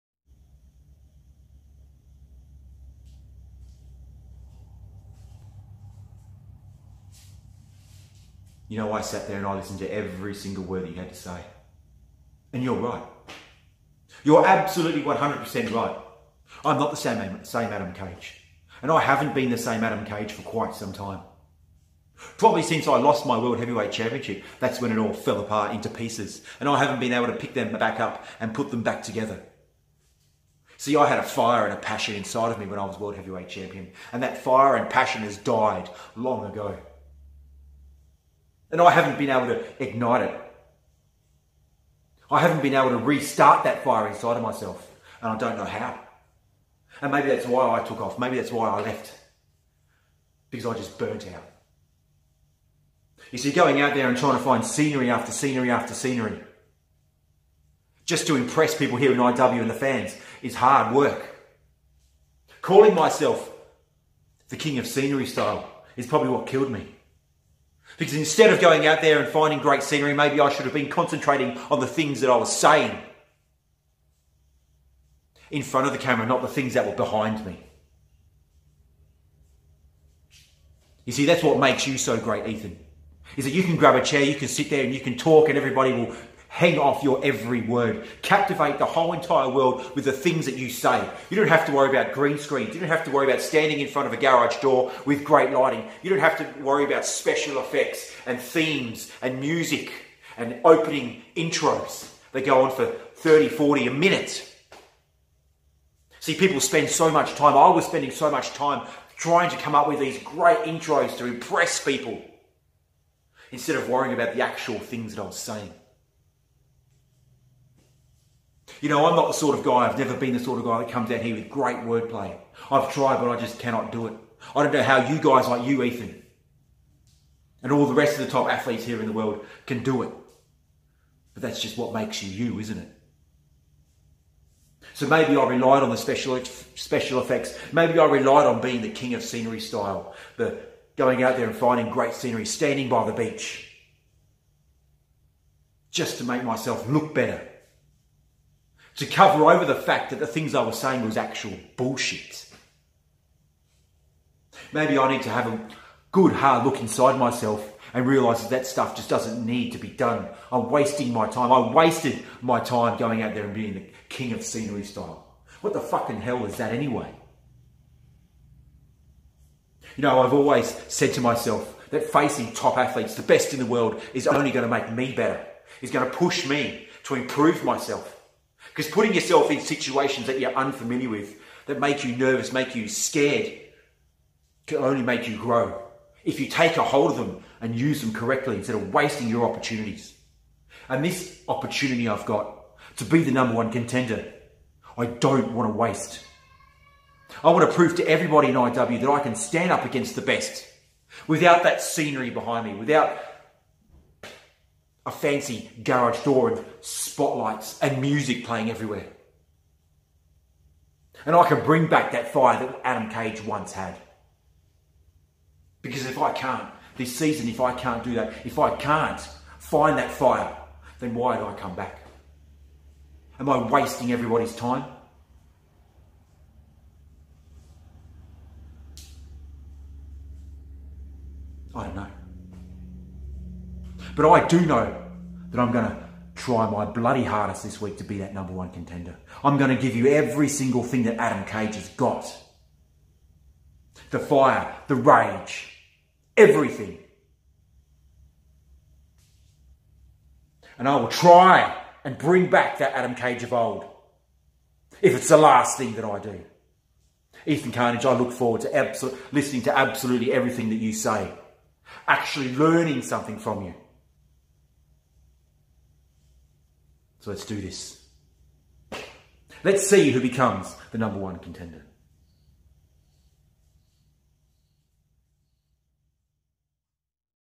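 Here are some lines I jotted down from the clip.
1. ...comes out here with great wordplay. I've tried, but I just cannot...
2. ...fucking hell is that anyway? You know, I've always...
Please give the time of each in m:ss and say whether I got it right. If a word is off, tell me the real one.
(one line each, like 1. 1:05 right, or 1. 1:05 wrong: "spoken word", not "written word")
1. 2:00 right
2. 2:45 right.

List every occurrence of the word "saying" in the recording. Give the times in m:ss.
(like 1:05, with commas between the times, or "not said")
1:12, 1:55, 2:30.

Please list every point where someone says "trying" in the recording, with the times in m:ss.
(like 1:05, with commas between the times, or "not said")
0:54, 1:49.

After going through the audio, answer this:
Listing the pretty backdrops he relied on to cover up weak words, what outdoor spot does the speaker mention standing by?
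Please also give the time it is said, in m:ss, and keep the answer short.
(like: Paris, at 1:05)
the beach, at 2:23.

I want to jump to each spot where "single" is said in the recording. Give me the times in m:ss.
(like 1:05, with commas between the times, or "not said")
0:10, 4:00.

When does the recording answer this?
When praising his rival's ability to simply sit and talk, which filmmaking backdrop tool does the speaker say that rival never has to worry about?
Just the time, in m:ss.
1:32.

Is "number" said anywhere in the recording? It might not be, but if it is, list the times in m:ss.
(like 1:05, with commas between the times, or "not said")
3:13, 3:58, 4:30.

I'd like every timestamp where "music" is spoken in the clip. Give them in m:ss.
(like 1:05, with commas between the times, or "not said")
1:39, 3:28.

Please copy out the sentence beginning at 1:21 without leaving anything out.
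You see, that's what makes you so great, Ethan.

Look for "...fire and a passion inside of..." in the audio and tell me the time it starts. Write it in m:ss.
0:31.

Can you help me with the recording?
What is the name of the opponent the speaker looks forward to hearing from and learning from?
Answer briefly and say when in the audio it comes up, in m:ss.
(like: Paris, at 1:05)
Ethan Carnage, at 4:17.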